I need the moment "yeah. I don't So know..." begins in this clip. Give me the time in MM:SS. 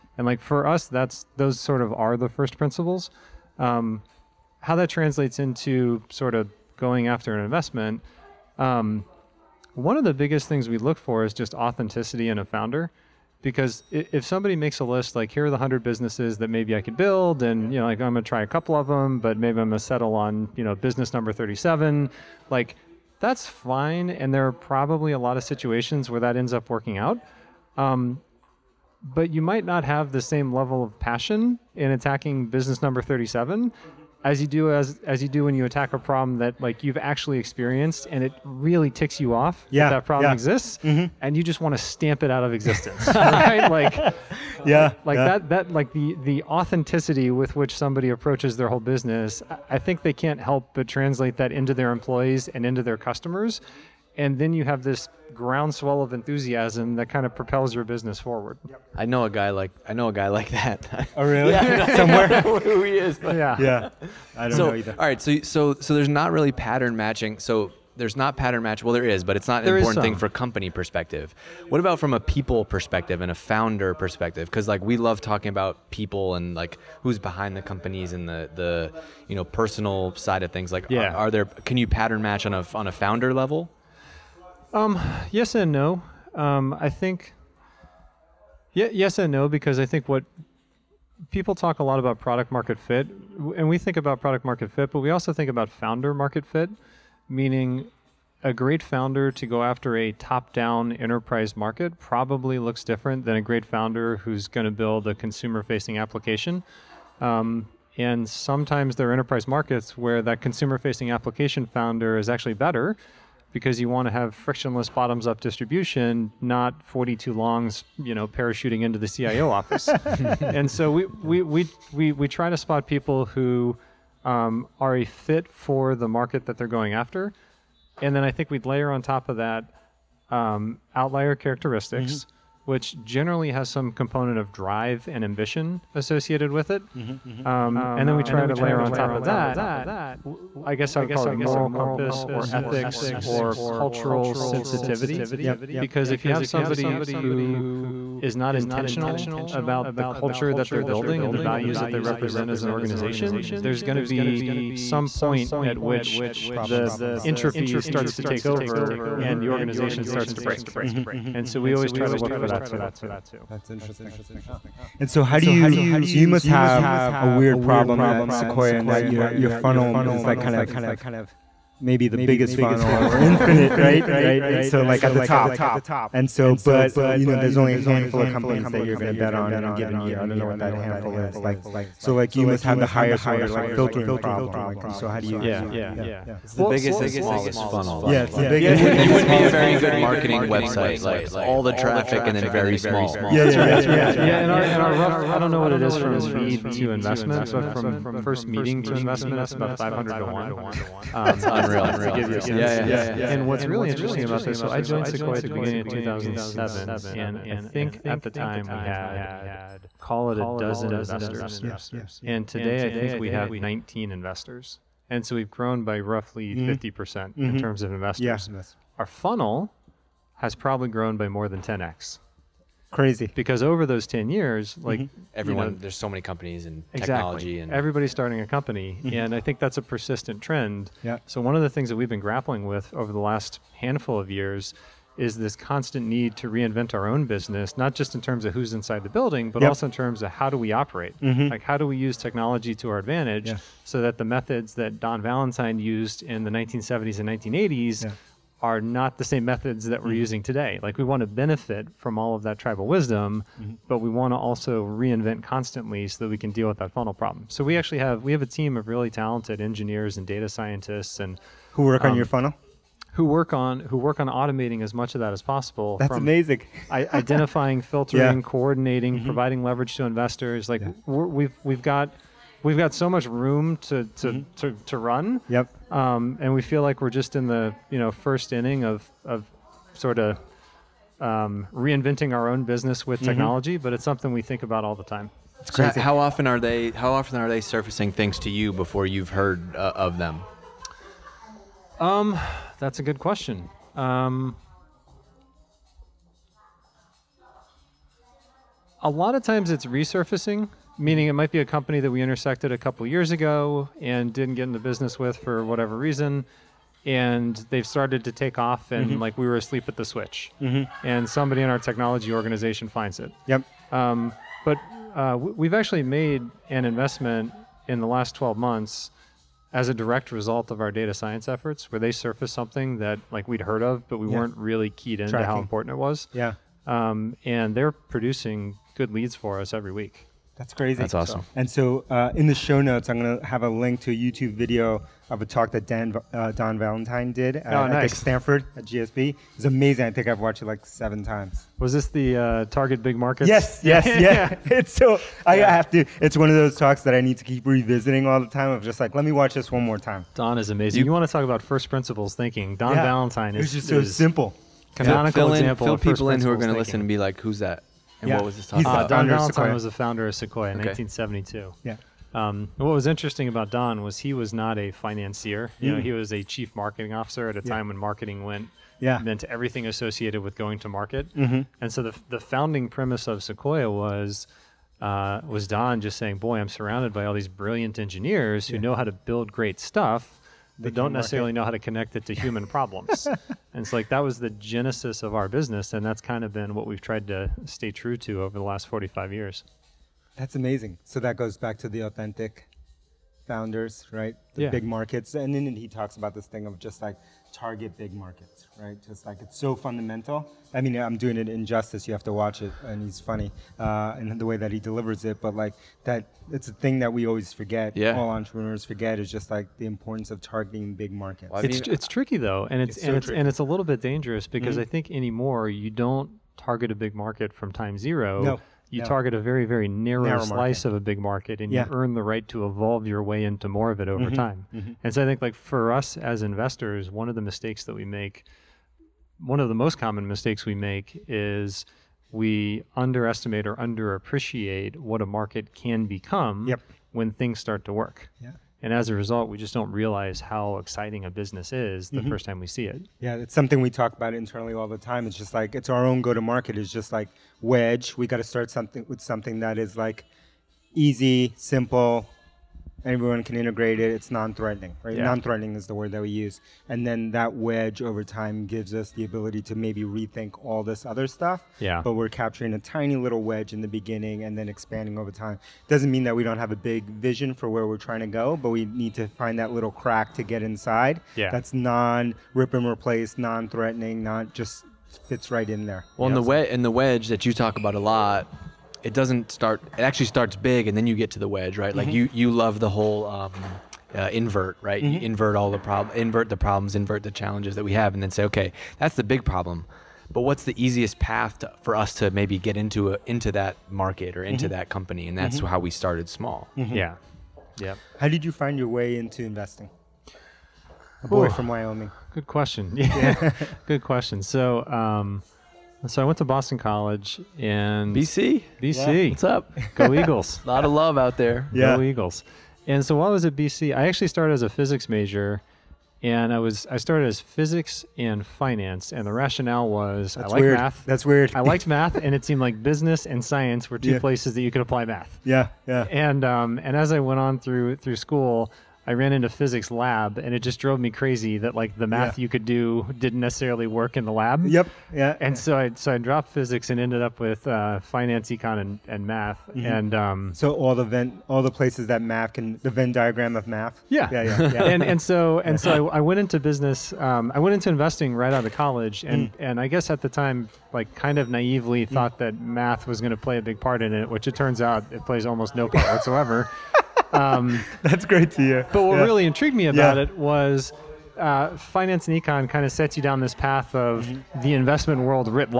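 01:03.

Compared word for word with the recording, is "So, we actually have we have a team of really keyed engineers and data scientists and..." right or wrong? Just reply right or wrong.
wrong.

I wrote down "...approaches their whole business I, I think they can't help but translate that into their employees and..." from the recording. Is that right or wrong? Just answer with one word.
right.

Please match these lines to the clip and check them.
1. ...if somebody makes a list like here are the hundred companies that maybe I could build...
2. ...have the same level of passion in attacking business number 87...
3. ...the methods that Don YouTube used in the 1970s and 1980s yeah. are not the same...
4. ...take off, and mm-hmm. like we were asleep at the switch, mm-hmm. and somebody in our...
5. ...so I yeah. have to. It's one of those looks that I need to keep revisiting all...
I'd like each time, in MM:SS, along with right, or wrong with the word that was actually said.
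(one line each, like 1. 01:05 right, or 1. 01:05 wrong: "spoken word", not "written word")
1. 00:13 wrong: "businesses", not "companies"
2. 00:29 wrong: "37", not "87"
3. 04:04 wrong: "Valentine", not "YouTube"
4. 05:08 right
5. 05:44 wrong: "talks", not "looks".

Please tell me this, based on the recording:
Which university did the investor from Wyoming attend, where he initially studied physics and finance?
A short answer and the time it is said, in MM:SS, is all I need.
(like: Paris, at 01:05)
Boston College, at 08:26.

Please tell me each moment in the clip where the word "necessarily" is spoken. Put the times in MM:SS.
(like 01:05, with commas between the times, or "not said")
06:21, 08:53.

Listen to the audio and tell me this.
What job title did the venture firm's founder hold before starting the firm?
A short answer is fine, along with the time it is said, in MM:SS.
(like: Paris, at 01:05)
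chief marketing officer, at 06:06.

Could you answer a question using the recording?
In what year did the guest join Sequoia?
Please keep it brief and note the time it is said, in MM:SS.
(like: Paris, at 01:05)
2007, at 03:25.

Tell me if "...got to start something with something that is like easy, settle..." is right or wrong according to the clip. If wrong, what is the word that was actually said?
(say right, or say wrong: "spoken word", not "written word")
wrong: "simple", not "settle".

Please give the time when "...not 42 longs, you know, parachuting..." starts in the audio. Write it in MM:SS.
01:56.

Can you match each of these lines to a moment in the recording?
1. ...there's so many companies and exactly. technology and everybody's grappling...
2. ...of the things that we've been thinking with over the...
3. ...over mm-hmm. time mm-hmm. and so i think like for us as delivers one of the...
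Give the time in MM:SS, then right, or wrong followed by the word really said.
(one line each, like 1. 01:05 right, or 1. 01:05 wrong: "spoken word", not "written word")
1. 03:45 wrong: "starting", not "grappling"
2. 03:51 wrong: "grappling", not "thinking"
3. 07:04 wrong: "investors", not "delivers".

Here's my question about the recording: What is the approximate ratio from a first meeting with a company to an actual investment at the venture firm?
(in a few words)
500 to 1.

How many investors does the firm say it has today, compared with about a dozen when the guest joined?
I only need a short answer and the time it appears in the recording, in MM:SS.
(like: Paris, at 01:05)
19, at 03:33.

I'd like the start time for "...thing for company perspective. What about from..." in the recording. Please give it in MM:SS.
01:10.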